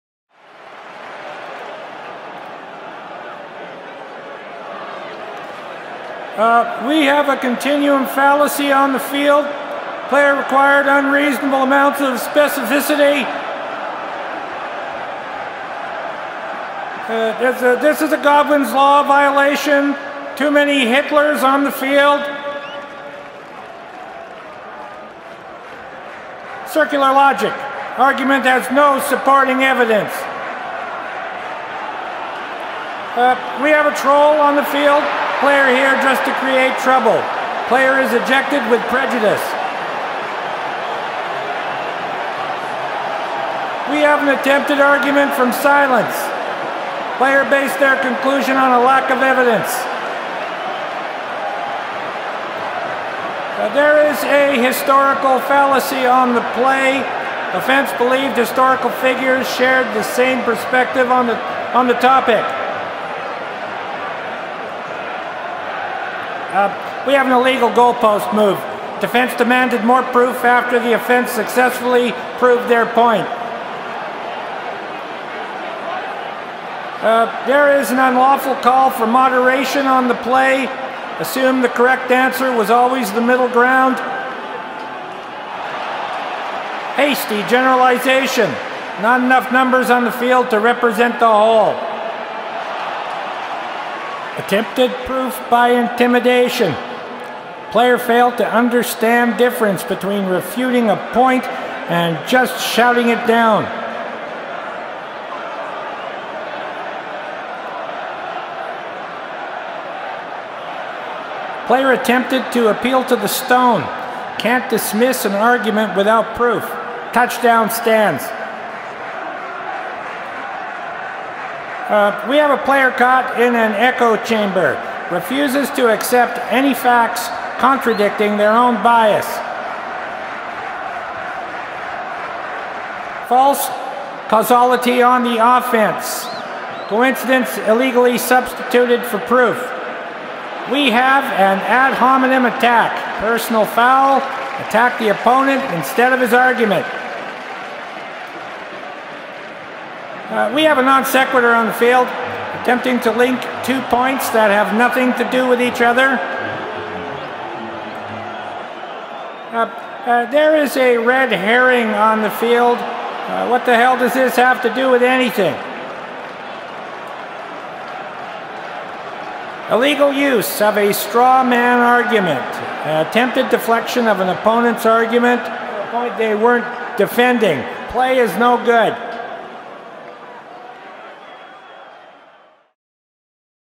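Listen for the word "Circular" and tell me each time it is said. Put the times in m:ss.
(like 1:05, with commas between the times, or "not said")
0:26.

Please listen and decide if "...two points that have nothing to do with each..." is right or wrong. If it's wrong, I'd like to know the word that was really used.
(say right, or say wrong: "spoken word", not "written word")
right.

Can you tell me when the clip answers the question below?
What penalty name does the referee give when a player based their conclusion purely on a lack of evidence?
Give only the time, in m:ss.
0:44.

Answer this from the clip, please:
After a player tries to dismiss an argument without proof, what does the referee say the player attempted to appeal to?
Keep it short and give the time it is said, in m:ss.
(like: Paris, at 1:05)
the stone, at 1:53.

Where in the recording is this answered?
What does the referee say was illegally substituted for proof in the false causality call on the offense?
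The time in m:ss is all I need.
2:16.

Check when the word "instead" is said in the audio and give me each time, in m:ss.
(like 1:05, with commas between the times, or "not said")
2:25.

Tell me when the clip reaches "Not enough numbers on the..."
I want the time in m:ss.
1:29.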